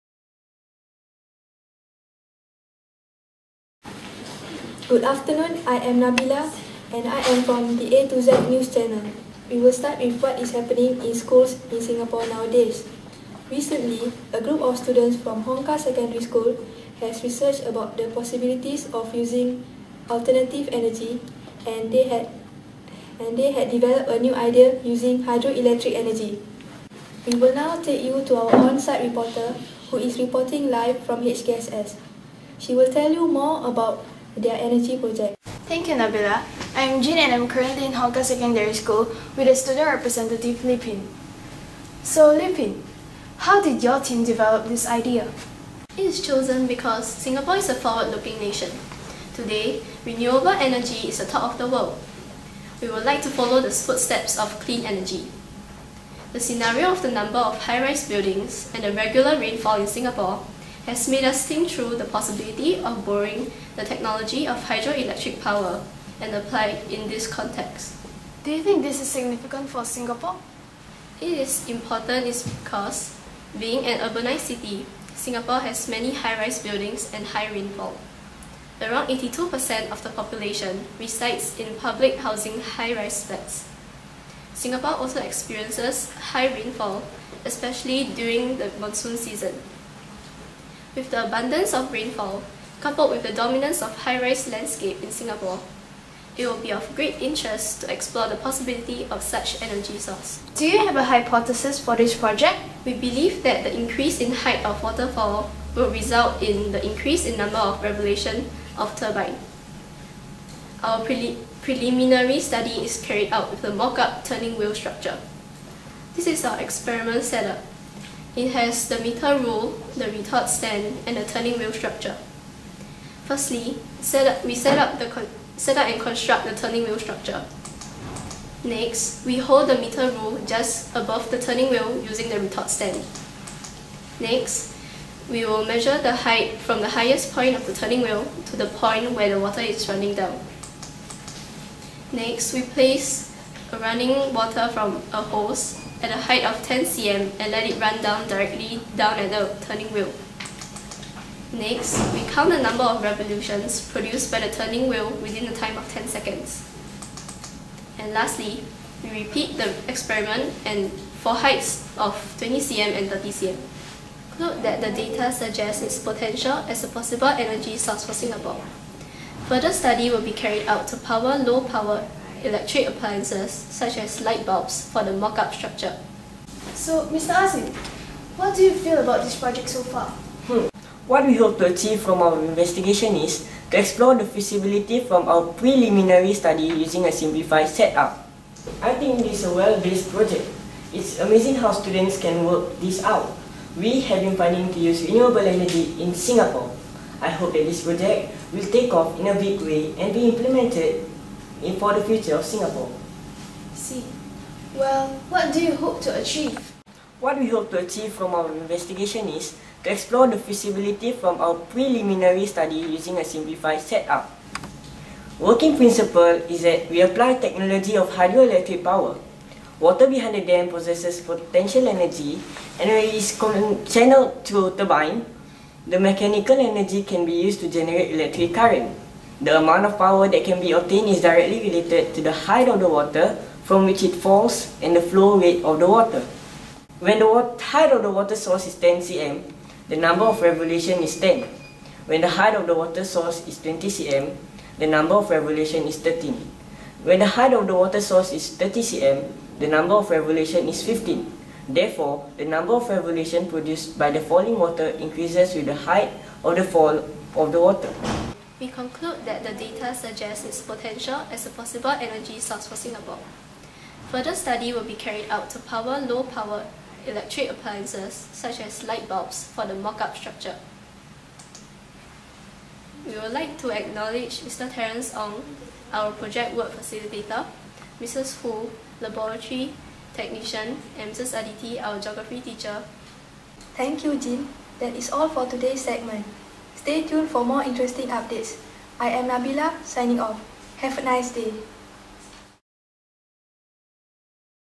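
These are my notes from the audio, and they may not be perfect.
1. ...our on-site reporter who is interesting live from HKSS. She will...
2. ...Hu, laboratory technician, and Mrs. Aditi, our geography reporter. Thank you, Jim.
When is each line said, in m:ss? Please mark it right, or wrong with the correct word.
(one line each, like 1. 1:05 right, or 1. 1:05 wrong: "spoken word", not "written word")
1. 0:28 wrong: "reporting", not "interesting"
2. 4:38 wrong: "teacher", not "reporter".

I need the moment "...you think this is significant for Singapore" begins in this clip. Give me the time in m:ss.
1:08.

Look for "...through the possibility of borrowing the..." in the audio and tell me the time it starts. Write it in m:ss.
1:01.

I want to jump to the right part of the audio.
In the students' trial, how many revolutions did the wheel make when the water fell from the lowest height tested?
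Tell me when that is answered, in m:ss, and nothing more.
3:59.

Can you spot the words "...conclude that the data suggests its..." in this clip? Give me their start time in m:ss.
4:18.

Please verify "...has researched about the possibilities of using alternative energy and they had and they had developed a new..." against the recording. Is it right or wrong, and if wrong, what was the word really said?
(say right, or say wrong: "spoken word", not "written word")
right.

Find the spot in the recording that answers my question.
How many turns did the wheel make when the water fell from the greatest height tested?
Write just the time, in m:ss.
4:09.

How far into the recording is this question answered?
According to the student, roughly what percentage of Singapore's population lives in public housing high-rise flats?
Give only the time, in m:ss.
1:19.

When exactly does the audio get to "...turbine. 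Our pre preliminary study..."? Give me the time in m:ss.
1:48.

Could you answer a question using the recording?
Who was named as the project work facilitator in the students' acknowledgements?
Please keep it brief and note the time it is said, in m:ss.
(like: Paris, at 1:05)
Terence Ong, at 4:34.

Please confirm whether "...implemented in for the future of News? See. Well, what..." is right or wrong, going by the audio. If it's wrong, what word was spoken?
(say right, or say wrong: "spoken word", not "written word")
wrong: "Singapore", not "News".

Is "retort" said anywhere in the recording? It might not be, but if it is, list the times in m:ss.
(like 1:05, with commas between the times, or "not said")
2:00, 2:12.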